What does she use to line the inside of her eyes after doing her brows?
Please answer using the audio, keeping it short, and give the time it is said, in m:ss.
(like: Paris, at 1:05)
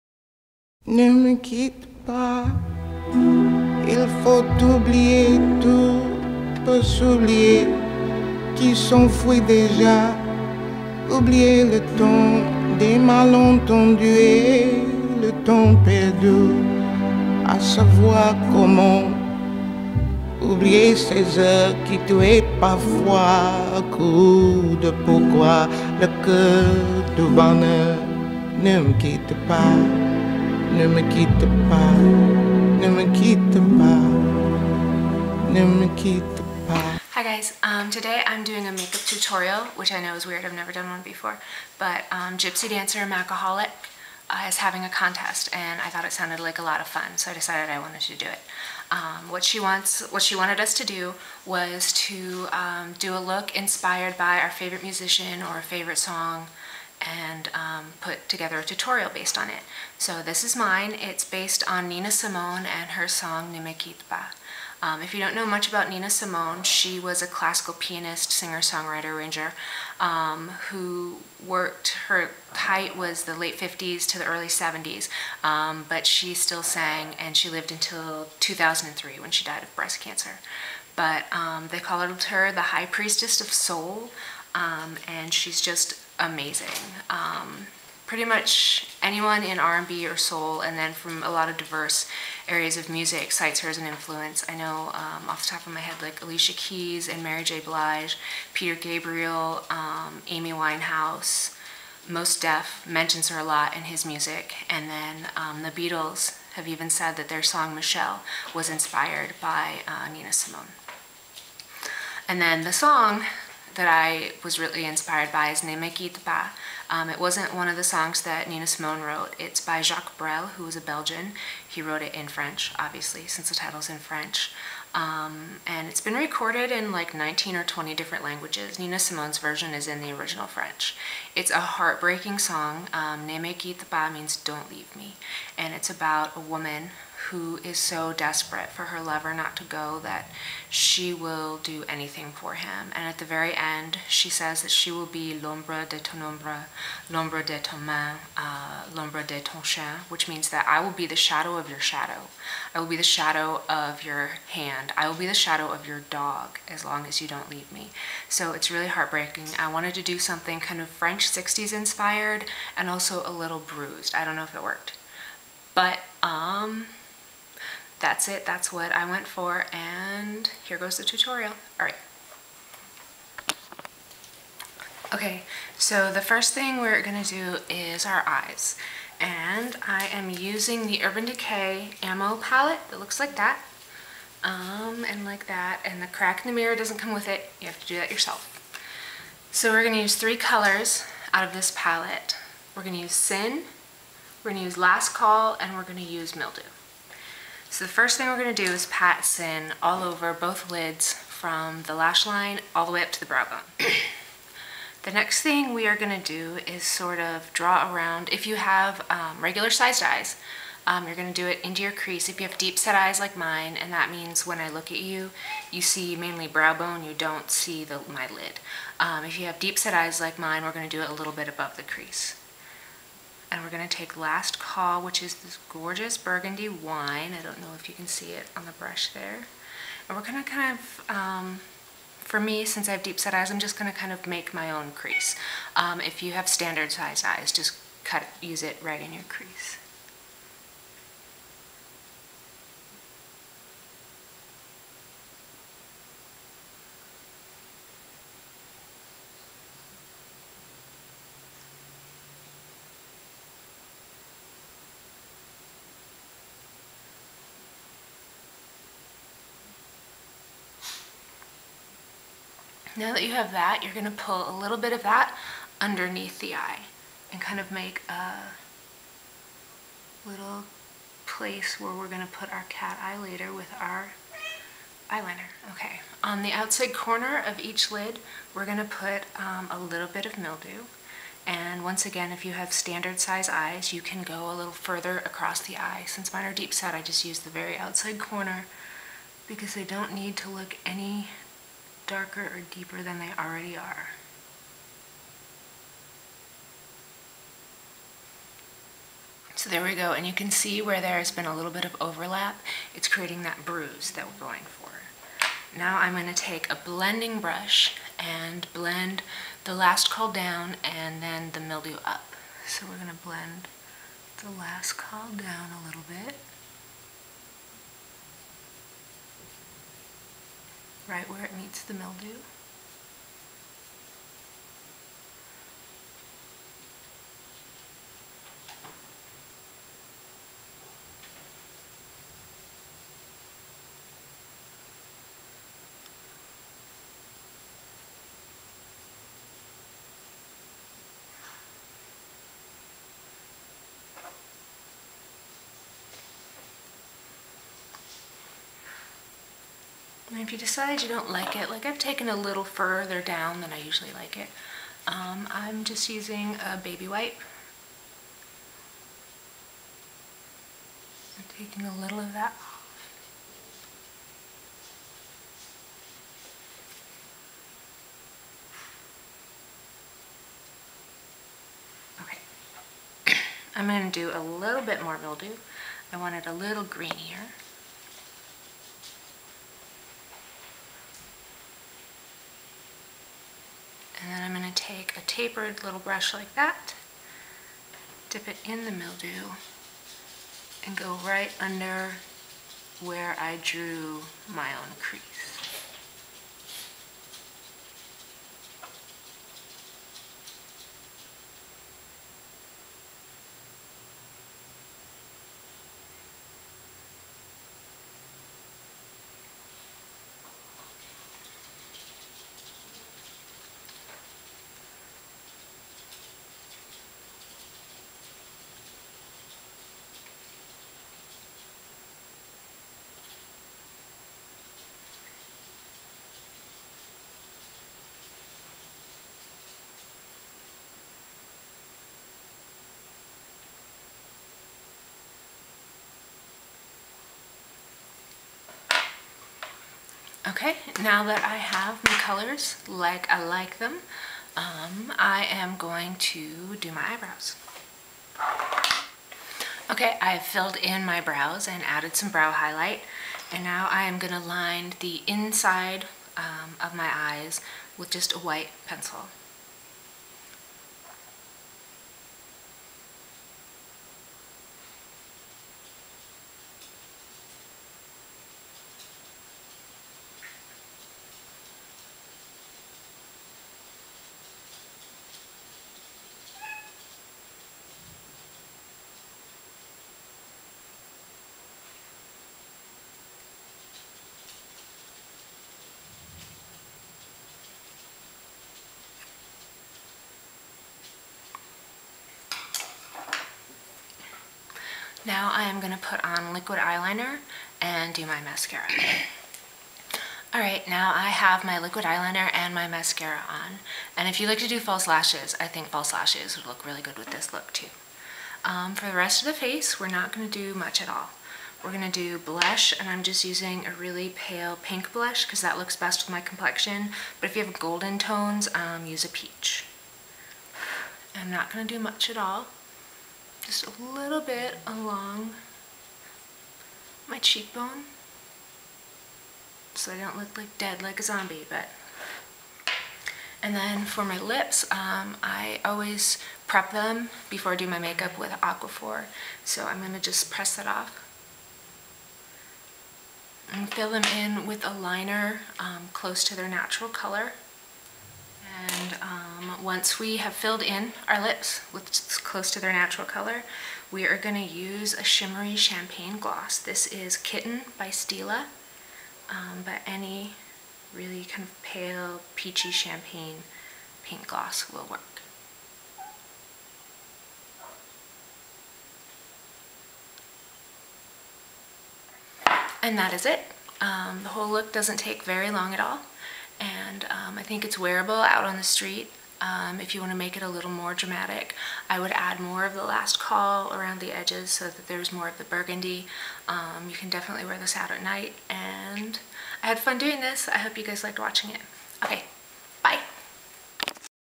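white pencil, at 7:38.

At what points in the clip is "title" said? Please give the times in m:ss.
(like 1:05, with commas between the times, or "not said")
2:03.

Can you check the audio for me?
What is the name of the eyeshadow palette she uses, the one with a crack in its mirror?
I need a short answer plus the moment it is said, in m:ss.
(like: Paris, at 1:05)
Ammo, at 3:02.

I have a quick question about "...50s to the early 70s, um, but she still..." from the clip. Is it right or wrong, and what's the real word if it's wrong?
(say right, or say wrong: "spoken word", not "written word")
right.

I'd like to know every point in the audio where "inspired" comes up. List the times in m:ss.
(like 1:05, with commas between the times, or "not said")
0:53, 1:48, 1:54, 2:41.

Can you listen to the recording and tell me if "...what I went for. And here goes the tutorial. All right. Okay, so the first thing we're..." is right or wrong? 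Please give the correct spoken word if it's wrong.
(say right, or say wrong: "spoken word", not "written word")
right.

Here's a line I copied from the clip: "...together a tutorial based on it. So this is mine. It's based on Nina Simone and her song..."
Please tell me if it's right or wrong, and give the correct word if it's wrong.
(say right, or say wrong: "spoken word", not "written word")
right.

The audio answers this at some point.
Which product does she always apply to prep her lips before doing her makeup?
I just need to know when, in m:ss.
8:58.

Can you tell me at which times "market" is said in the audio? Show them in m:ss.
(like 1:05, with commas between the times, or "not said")
not said.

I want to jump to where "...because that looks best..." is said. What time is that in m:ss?
8:35.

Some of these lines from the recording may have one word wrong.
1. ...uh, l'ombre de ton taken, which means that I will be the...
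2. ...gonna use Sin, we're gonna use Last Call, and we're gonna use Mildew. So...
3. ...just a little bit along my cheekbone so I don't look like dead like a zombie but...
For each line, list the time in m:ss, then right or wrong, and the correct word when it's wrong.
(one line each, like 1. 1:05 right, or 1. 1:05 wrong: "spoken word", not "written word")
1. 2:28 wrong: "chien", not "taken"
2. 3:12 right
3. 8:43 right.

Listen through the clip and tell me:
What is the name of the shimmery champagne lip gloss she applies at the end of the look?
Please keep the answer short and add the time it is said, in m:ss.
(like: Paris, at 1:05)
Kitten, at 9:17.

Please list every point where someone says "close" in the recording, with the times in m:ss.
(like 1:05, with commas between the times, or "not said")
9:06, 9:12.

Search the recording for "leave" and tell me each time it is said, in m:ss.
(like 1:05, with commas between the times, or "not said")
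2:14, 2:37.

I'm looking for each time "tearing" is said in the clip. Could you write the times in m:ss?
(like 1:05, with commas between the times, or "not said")
not said.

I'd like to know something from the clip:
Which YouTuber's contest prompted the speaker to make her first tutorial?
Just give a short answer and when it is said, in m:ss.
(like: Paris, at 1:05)
Gypsy Dancer Macaholic, at 0:42.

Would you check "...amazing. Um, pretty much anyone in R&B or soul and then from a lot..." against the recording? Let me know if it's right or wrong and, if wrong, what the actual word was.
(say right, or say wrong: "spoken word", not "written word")
right.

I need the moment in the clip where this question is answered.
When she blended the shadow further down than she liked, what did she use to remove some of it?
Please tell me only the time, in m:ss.
5:56.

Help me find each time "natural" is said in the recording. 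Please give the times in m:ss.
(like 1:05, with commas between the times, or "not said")
9:06, 9:12.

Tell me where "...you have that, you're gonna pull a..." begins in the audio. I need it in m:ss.
4:23.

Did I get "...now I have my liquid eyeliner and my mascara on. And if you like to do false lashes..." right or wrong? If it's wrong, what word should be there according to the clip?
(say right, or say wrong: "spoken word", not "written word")
right.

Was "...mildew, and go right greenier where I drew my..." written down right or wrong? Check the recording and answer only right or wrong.
wrong.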